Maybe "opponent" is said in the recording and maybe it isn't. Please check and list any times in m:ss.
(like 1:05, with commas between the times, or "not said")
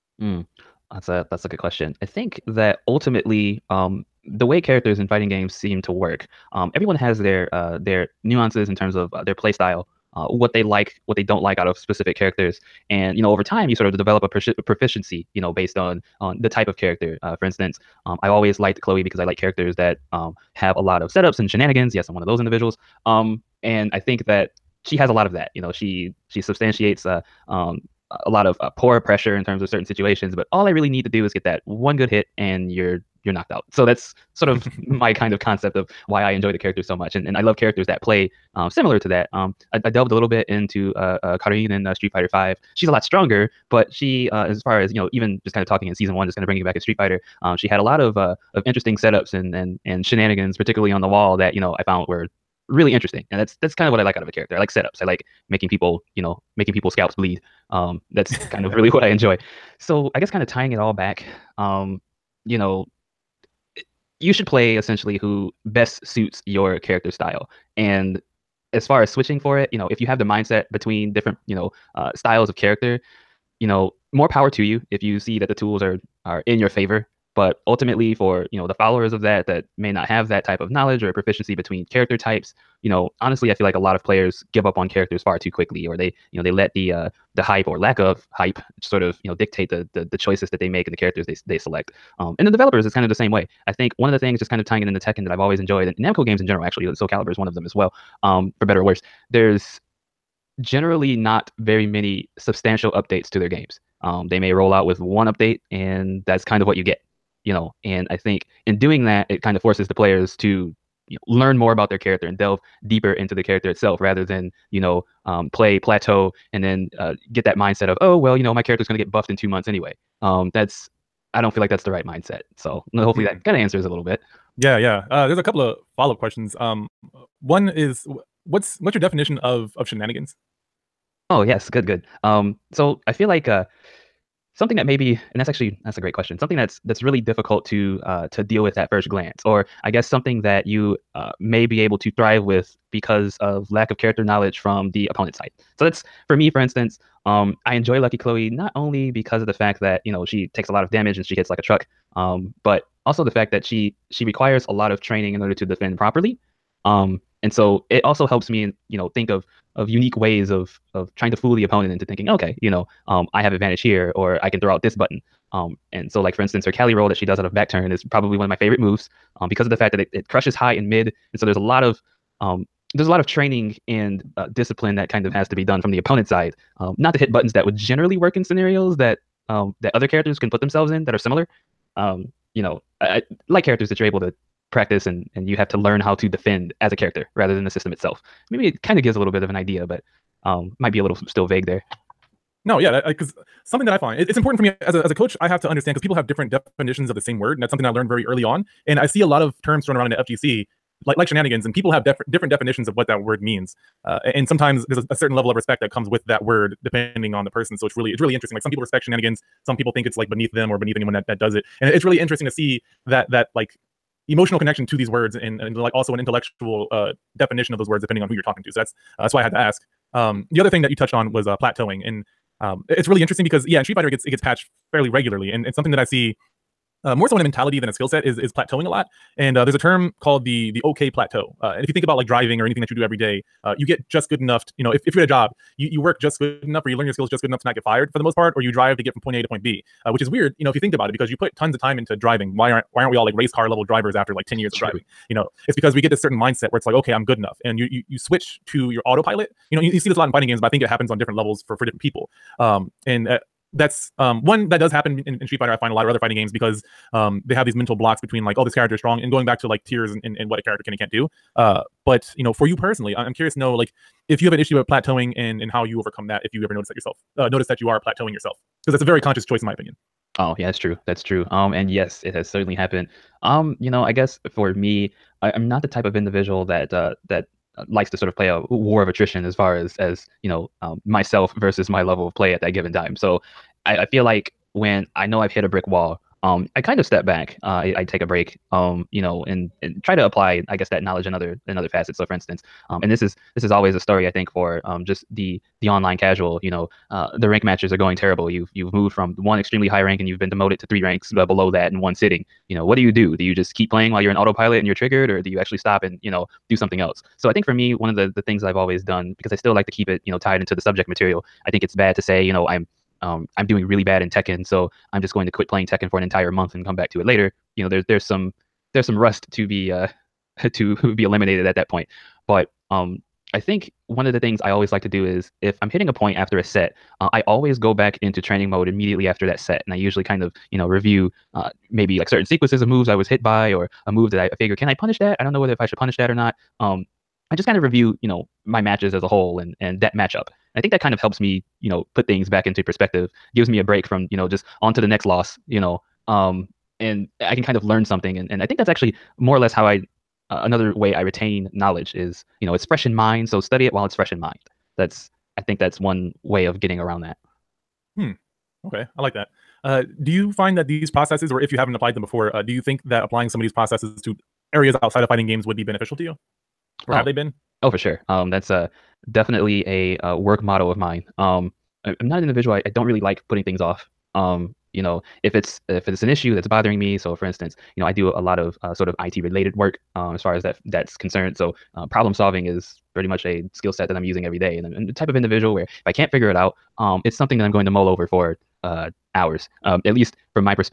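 2:25, 2:41, 2:55.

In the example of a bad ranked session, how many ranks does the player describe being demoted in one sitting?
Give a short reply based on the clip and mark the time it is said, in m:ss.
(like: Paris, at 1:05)
3, at 5:00.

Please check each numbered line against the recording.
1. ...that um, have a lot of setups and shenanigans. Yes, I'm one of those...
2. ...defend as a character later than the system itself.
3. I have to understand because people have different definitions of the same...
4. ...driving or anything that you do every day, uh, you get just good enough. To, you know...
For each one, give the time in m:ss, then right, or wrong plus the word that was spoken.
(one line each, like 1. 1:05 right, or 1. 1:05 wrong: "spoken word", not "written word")
1. 0:19 right
2. 3:06 wrong: "rather", not "later"
3. 3:15 right
4. 3:52 right.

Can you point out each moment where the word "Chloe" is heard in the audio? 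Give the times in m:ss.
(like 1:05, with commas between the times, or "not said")
0:18, 2:28.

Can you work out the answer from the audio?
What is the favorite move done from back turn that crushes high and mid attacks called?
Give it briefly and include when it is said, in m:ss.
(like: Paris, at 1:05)
Cali roll, at 2:46.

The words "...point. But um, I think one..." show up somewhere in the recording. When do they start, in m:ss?
5:21.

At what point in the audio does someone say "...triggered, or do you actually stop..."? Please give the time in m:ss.
5:04.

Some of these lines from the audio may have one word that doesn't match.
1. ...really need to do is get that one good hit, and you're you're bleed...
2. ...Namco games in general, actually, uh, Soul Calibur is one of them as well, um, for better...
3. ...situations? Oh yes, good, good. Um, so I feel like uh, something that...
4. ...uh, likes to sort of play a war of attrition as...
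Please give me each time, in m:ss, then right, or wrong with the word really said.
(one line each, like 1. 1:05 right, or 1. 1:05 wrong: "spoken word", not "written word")
1. 0:30 wrong: "knocked", not "bleed"
2. 1:35 right
3. 2:09 wrong: "shenanigans", not "situations"
4. 4:37 right.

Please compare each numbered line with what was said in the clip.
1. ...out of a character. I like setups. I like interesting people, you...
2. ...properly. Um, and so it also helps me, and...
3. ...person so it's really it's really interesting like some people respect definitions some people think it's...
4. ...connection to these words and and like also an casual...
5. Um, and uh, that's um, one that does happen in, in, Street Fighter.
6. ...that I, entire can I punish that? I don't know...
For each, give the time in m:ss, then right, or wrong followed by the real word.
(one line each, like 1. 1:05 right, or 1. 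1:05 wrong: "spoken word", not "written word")
1. 0:54 wrong: "making", not "interesting"
2. 2:35 right
3. 3:27 wrong: "shenanigans", not "definitions"
4. 3:34 wrong: "intellectual", not "casual"
5. 4:12 right
6. 5:34 wrong: "figure", not "entire".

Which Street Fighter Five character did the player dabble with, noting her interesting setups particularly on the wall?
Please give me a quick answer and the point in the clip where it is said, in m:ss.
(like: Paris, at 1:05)
Karin, at 0:41.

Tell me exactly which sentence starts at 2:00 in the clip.
Um, that's, I don't feel like that's the right mindset.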